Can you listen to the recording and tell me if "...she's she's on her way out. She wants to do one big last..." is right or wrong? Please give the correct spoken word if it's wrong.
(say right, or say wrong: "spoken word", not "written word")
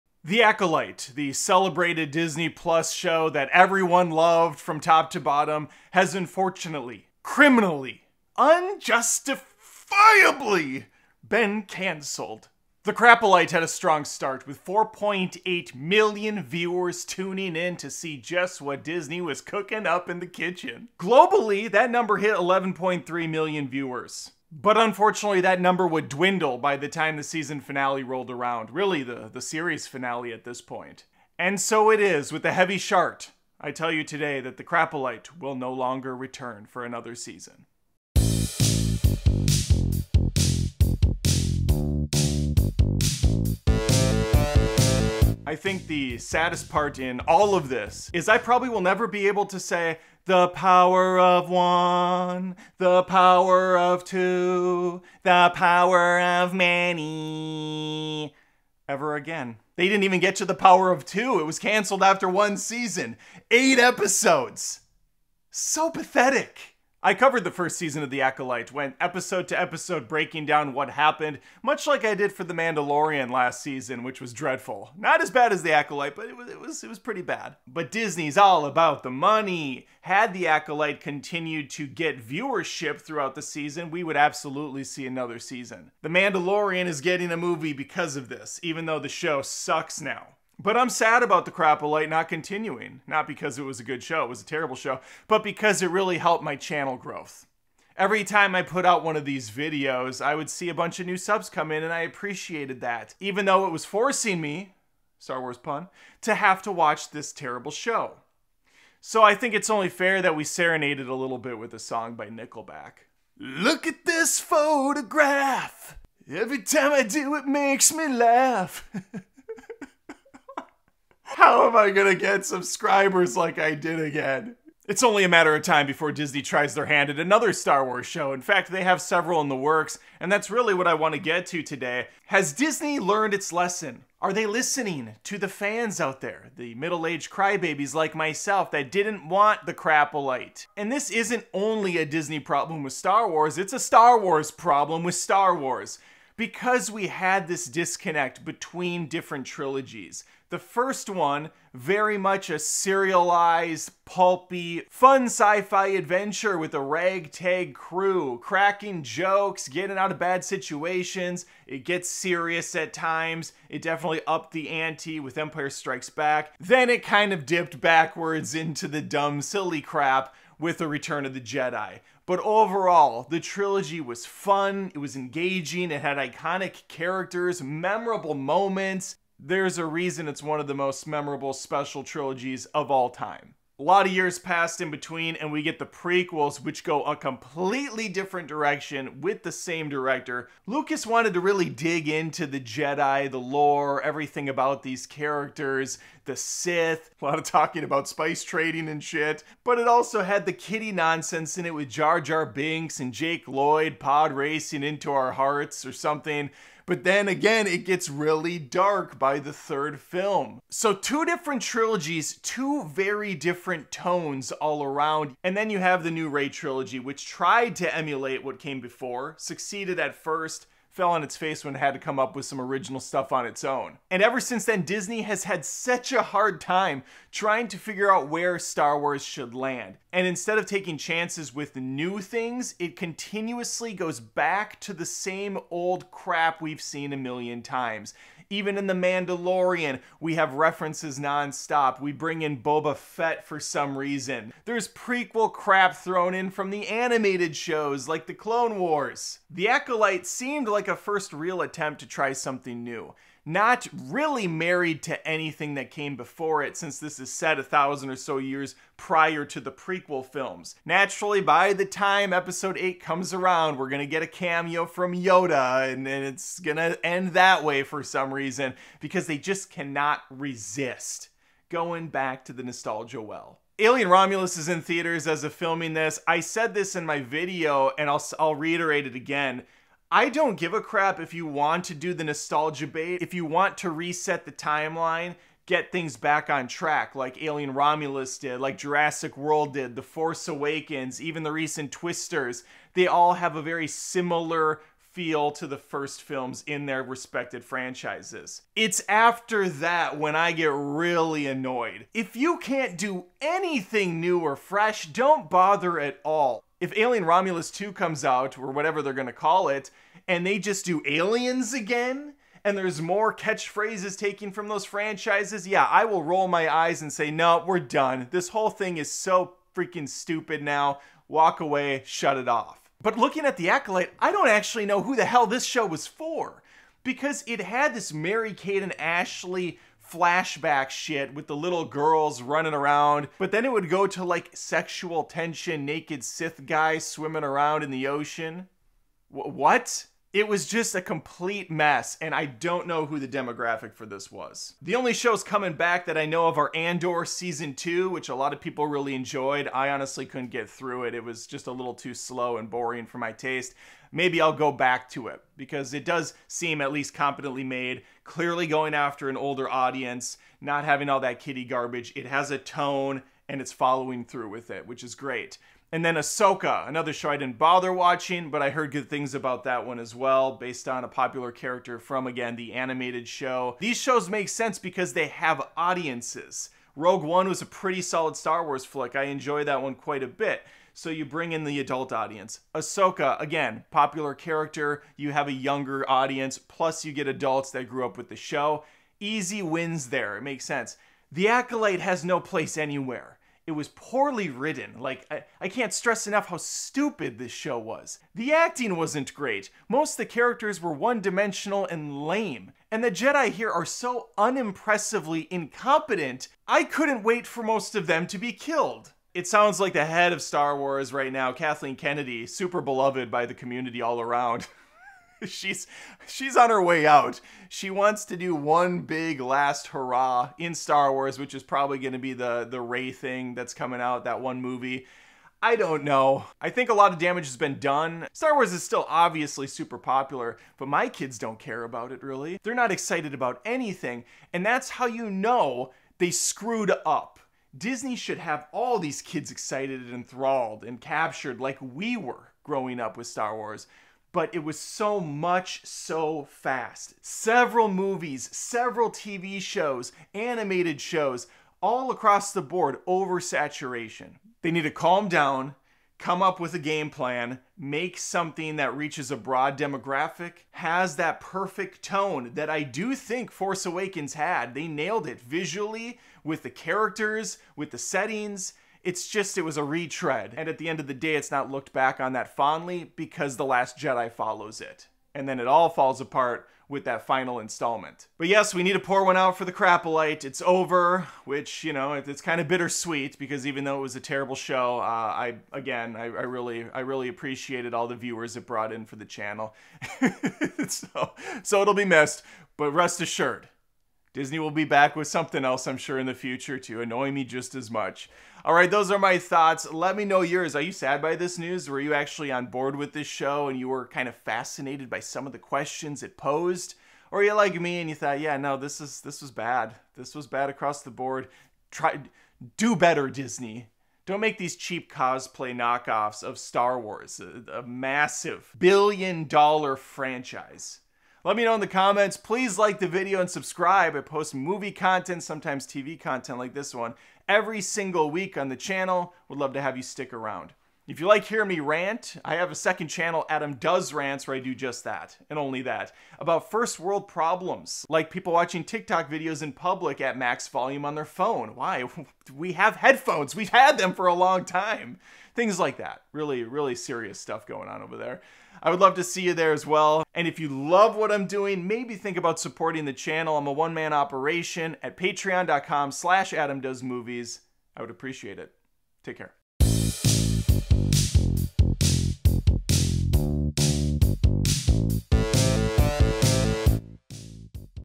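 right.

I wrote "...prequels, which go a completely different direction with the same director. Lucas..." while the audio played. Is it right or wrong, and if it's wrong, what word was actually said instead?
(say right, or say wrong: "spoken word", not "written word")
right.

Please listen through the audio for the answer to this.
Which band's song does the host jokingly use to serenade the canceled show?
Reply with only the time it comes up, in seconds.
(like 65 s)
112 s.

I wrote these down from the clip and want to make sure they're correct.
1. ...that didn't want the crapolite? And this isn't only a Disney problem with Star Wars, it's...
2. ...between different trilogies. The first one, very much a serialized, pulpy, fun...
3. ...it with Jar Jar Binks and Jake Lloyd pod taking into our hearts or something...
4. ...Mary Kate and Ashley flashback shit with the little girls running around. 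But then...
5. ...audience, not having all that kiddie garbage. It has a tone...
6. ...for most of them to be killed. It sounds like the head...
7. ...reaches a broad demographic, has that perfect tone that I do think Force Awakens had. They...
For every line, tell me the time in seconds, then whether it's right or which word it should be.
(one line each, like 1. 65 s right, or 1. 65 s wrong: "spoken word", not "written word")
1. 138 s right
2. 148 s right
3. 201 s wrong: "racing", not "taking"
4. 328 s right
5. 359 s right
6. 407 s right
7. 458 s right.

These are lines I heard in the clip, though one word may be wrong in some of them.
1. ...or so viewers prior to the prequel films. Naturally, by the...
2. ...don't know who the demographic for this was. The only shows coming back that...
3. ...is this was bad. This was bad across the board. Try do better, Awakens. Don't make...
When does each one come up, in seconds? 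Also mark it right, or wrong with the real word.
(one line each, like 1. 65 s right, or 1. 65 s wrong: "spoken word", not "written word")
1. 258 s wrong: "years", not "viewers"
2. 342 s right
3. 509 s wrong: "Disney", not "Awakens".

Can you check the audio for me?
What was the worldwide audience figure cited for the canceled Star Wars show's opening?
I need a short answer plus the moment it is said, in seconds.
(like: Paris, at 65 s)
11.3 million, at 22 s.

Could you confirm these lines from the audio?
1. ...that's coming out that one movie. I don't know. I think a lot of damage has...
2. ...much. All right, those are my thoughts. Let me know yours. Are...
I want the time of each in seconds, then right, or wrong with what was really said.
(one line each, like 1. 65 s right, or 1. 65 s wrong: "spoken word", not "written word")
1. 423 s right
2. 497 s right.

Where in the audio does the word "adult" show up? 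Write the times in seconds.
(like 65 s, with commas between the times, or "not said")
381 s, 387 s.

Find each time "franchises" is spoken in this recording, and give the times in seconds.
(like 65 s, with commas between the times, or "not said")
297 s, 314 s, 519 s.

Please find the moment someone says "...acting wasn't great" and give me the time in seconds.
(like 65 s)
398 s.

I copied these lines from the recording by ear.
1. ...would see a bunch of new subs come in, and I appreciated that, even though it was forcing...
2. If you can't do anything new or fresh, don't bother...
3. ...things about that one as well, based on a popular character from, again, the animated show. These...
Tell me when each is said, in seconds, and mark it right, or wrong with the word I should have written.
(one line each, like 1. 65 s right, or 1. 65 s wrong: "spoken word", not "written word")
1. 100 s right
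2. 302 s right
3. 369 s right.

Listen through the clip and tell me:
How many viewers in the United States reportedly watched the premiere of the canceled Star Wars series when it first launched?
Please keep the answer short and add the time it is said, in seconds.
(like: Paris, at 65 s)
4.8 million, at 14 s.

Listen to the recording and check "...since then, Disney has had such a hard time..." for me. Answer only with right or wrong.
right.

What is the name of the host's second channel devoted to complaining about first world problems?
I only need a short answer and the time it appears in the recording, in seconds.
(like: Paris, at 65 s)
Adam Does Rants, at 533 s.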